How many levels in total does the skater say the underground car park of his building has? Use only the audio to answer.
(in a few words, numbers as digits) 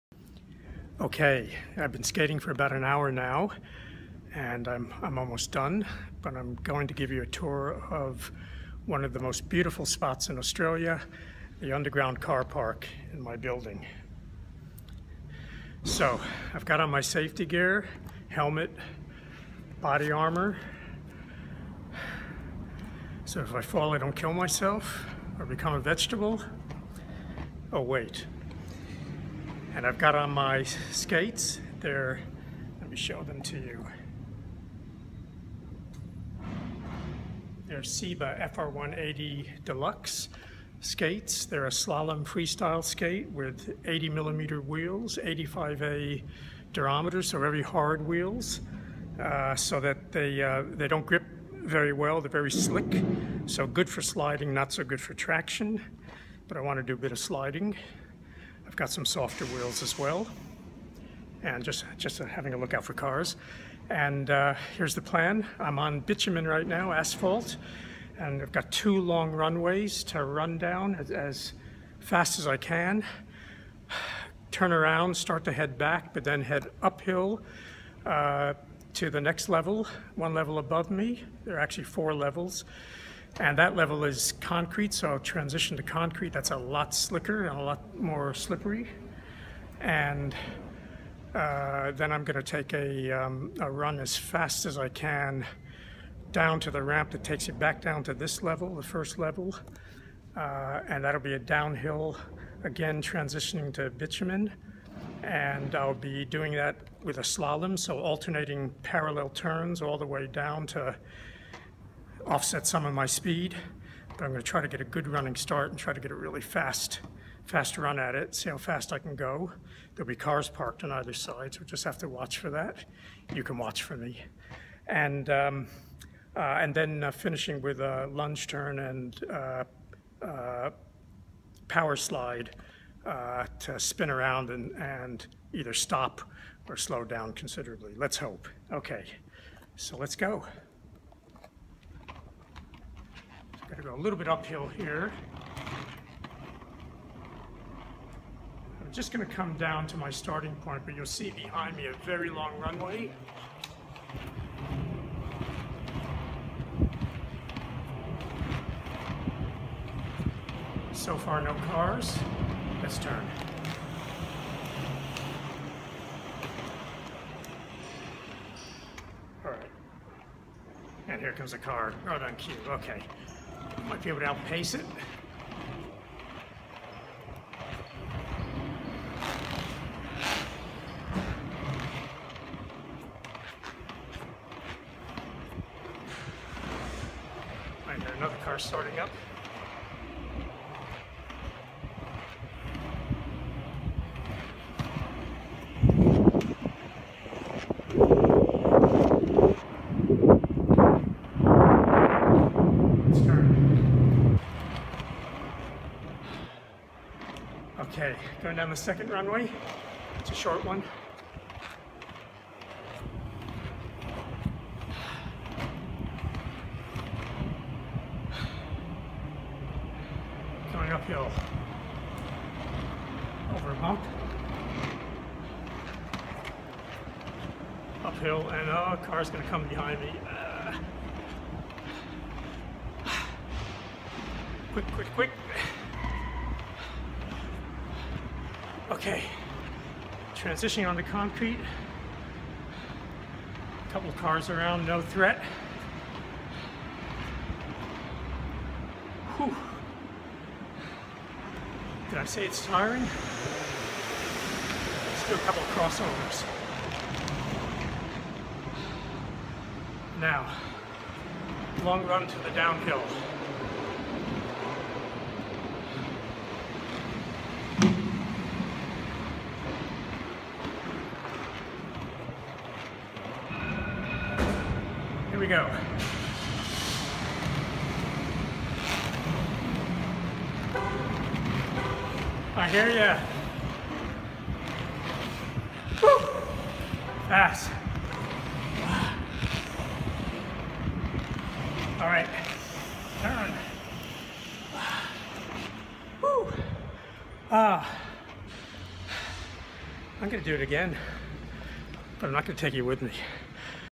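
4.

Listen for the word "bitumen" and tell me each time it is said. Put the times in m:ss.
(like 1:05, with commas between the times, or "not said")
1:05, 1:43.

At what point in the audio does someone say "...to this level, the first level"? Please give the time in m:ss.
1:38.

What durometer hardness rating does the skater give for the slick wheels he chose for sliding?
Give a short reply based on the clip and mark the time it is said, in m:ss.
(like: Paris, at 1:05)
85A, at 0:45.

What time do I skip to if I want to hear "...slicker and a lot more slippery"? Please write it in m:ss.
1:26.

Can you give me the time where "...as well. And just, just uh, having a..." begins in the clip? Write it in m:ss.
0:59.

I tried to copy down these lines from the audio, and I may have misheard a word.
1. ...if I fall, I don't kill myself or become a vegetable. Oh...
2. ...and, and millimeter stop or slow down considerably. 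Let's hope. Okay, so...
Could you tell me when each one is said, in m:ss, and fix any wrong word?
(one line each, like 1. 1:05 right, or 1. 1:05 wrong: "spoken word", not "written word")
1. 0:23 right
2. 2:14 wrong: "either", not "millimeter".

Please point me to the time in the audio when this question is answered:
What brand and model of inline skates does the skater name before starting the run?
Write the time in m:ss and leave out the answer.
0:37.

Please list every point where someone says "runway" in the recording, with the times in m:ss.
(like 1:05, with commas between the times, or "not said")
1:09, 2:32, 3:29.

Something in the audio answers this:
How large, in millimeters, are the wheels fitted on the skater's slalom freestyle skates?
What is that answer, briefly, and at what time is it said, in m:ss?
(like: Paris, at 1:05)
80 millimeter, at 0:43.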